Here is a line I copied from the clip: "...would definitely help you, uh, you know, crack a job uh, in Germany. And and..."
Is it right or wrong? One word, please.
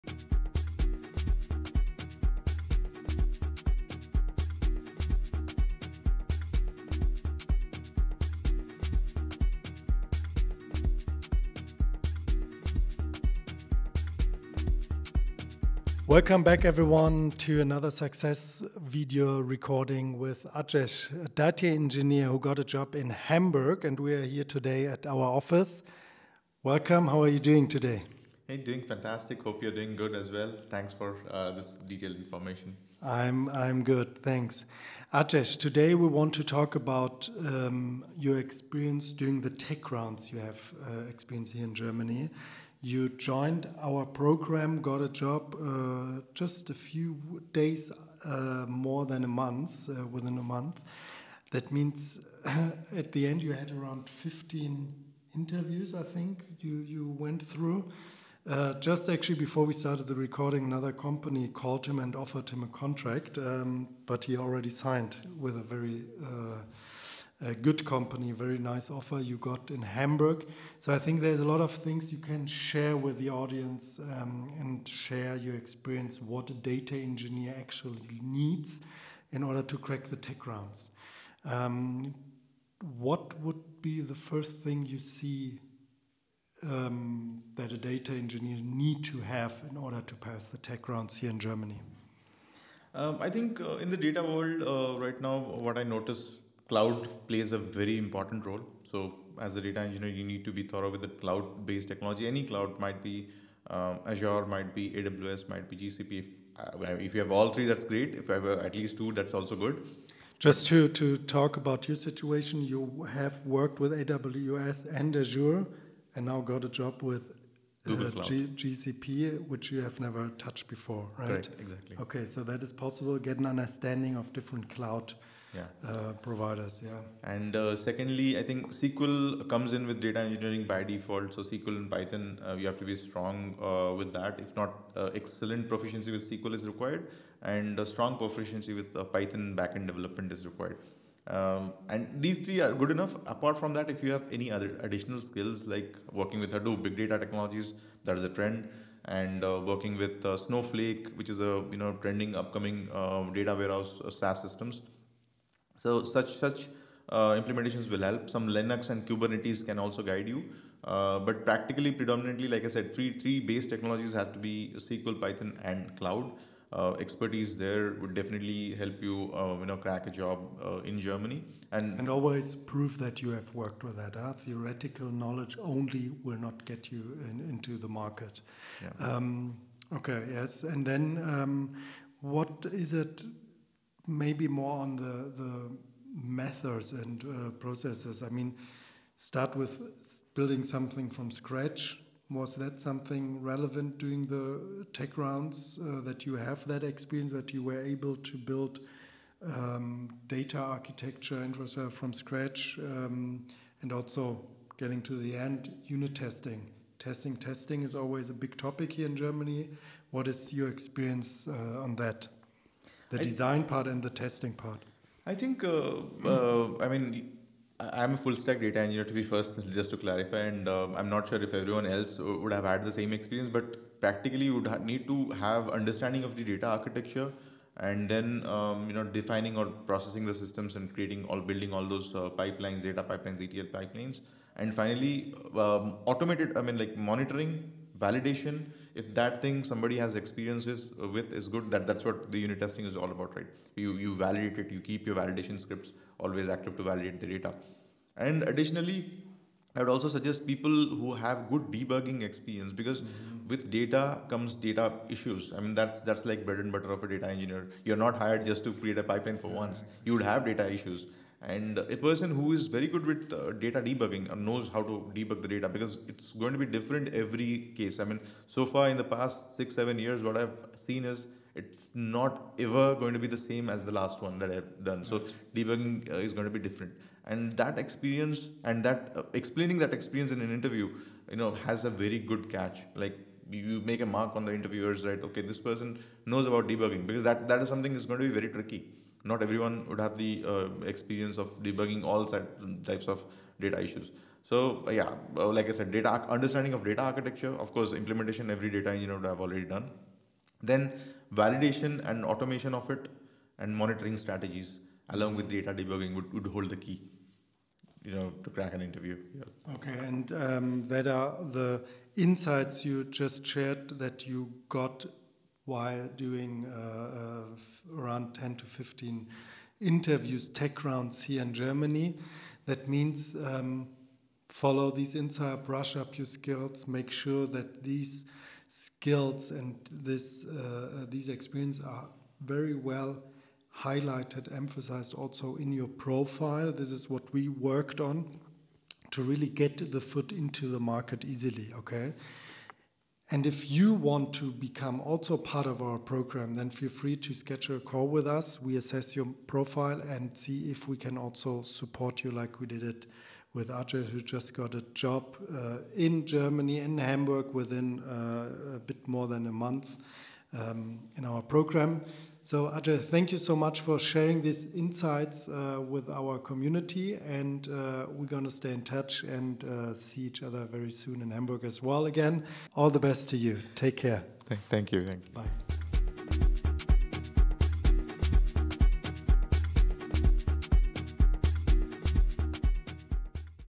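right.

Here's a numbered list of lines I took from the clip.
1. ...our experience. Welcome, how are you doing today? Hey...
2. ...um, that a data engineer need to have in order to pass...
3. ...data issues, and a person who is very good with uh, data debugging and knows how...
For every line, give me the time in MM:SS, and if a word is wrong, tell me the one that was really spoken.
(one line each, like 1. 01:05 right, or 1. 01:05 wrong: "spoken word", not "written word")
1. 00:25 wrong: "office", not "experience"
2. 01:26 right
3. 04:20 right.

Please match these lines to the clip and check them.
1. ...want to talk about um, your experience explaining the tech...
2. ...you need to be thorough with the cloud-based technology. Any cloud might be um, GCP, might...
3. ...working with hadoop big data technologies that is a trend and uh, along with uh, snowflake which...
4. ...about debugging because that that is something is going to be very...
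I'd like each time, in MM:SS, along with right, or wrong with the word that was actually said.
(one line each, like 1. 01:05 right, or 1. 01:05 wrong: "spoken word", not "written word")
1. 00:36 wrong: "during", not "explaining"
2. 01:40 wrong: "Azure", not "GCP"
3. 02:26 wrong: "working", not "along"
4. 04:46 right.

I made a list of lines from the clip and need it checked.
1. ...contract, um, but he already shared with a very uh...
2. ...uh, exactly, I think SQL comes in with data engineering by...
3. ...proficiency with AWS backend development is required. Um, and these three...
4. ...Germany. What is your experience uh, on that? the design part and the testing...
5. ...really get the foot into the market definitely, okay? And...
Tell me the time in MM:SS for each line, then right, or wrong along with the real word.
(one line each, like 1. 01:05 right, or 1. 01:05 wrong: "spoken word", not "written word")
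1. 01:02 wrong: "signed", not "shared"
2. 02:07 wrong: "secondly", not "exactly"
3. 02:18 wrong: "Python", not "AWS"
4. 03:29 right
5. 05:39 wrong: "easily", not "definitely".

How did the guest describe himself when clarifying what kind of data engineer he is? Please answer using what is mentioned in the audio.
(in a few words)
full stack data engineer.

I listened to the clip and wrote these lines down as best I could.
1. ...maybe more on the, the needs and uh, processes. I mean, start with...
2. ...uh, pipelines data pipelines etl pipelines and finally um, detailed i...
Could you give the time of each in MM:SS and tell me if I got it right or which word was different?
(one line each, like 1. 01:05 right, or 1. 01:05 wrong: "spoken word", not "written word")
1. 03:04 wrong: "methods", not "needs"
2. 03:52 wrong: "automated", not "detailed".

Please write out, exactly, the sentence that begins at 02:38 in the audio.
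Some Linux and Kubernetes can also guide you.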